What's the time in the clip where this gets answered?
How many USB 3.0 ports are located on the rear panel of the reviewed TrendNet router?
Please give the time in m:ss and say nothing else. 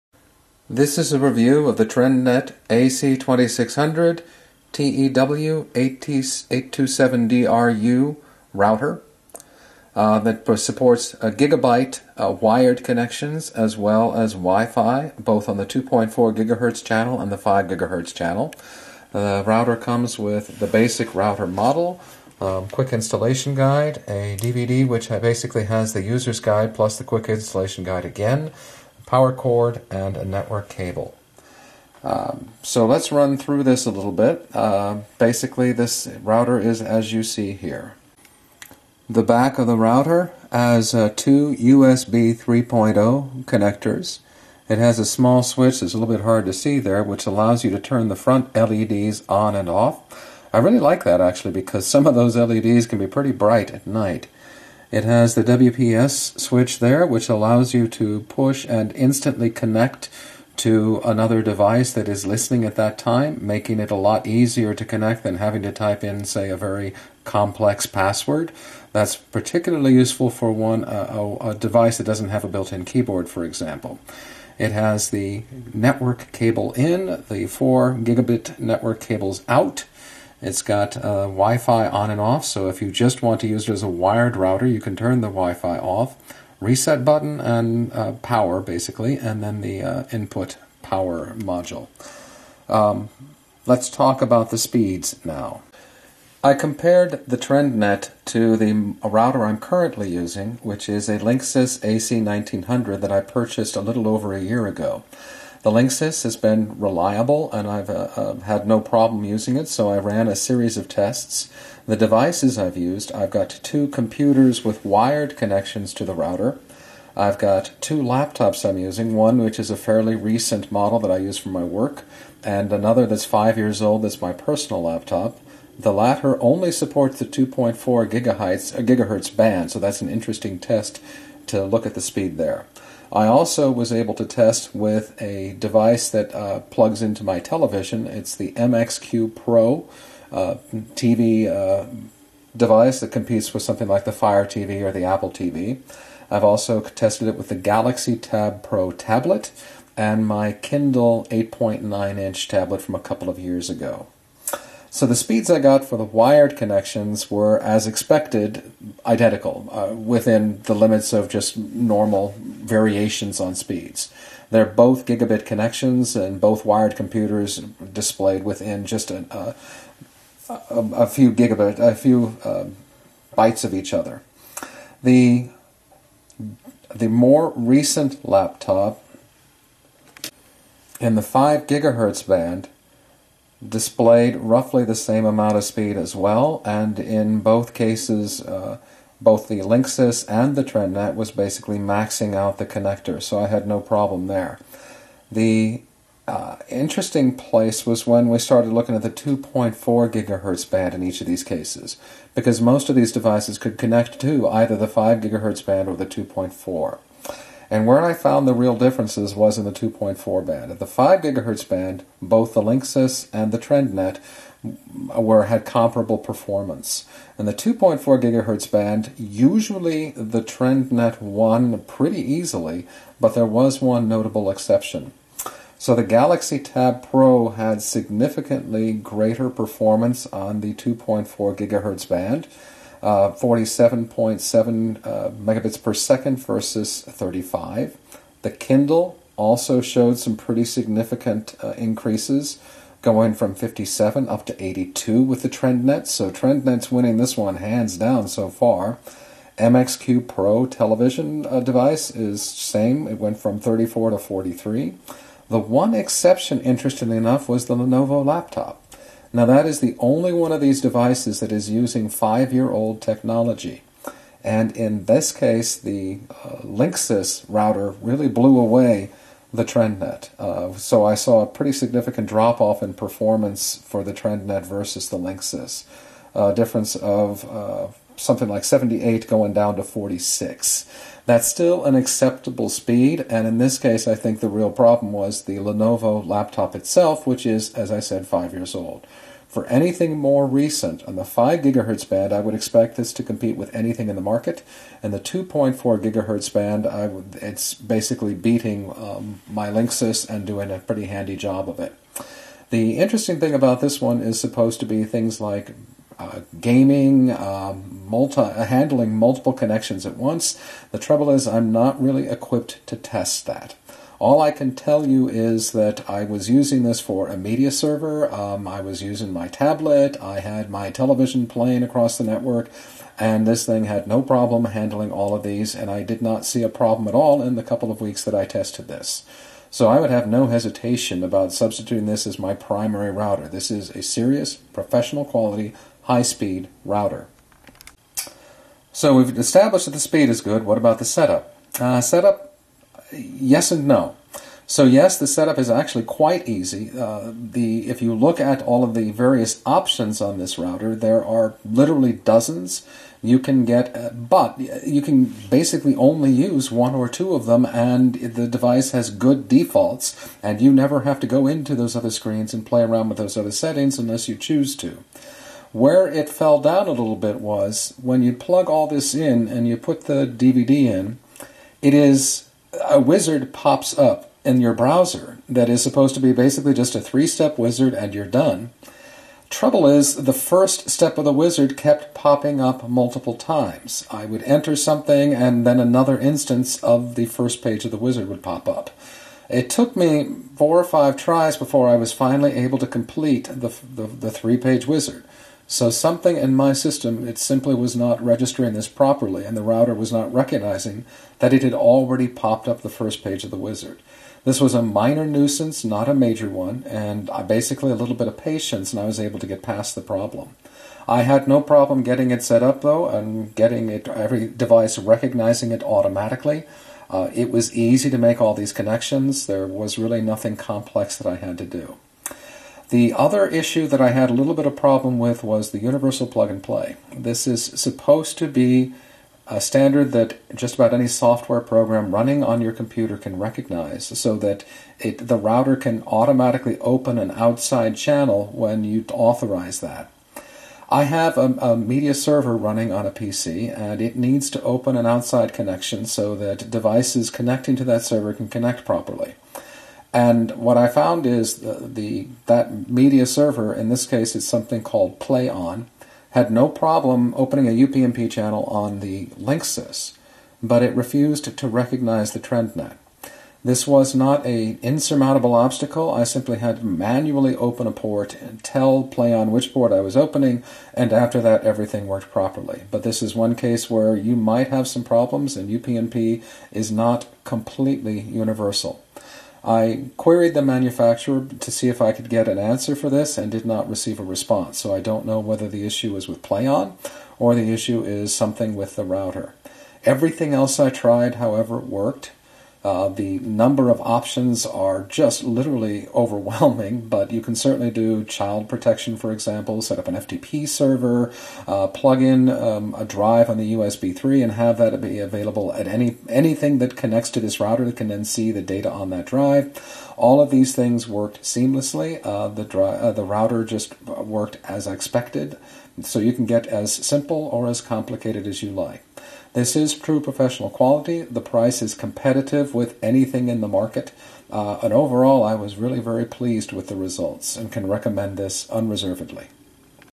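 0:41.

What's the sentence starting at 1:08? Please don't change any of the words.
That's particularly useful for one uh, a, a device that doesn't have a built-in keyboard, for example.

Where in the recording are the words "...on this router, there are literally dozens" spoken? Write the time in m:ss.
5:50.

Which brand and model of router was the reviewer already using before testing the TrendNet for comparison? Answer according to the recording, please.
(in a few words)
Linksys AC1900.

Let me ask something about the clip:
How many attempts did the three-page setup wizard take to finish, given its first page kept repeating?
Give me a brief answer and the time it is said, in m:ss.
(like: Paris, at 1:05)
4 or 5, at 6:30.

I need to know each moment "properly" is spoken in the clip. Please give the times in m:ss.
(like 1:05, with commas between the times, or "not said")
6:38, 7:28, 7:52.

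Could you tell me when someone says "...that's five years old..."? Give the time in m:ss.
2:03.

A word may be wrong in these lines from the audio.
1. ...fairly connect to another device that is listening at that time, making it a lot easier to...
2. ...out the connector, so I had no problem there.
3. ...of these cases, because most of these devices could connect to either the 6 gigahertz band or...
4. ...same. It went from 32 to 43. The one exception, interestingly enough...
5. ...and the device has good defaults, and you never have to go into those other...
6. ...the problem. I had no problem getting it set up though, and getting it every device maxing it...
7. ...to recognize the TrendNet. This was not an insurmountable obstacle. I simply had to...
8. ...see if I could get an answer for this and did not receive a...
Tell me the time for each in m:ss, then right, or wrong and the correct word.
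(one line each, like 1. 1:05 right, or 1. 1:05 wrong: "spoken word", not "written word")
1. 0:58 wrong: "instantly", not "fairly"
2. 3:12 right
3. 3:21 wrong: "5", not "6"
4. 4:12 wrong: "34", not "32"
5. 5:57 right
6. 6:49 wrong: "recognizing", not "maxing"
7. 7:41 right
8. 8:01 right.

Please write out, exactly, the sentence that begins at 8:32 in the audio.
Uh, the, dri- uh, the router just worked as expected, so you can get as simple or as complicated as you like.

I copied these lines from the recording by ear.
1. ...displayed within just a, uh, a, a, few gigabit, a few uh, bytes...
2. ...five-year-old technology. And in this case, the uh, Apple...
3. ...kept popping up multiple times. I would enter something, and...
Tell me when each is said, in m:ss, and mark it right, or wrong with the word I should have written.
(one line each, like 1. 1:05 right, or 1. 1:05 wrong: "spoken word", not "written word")
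1. 2:47 right
2. 4:22 wrong: "Linksys", not "Apple"
3. 6:21 right.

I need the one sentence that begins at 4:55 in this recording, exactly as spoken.
And the 2.4 gigahertz band, I would, it's basically beating um, my Linksys and doing a pretty handy job of it.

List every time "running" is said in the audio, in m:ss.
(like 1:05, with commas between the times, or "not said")
7:12, 7:22.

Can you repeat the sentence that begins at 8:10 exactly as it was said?
Everything else I tried, however, worked.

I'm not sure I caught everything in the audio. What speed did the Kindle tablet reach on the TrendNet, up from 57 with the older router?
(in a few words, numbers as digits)
82.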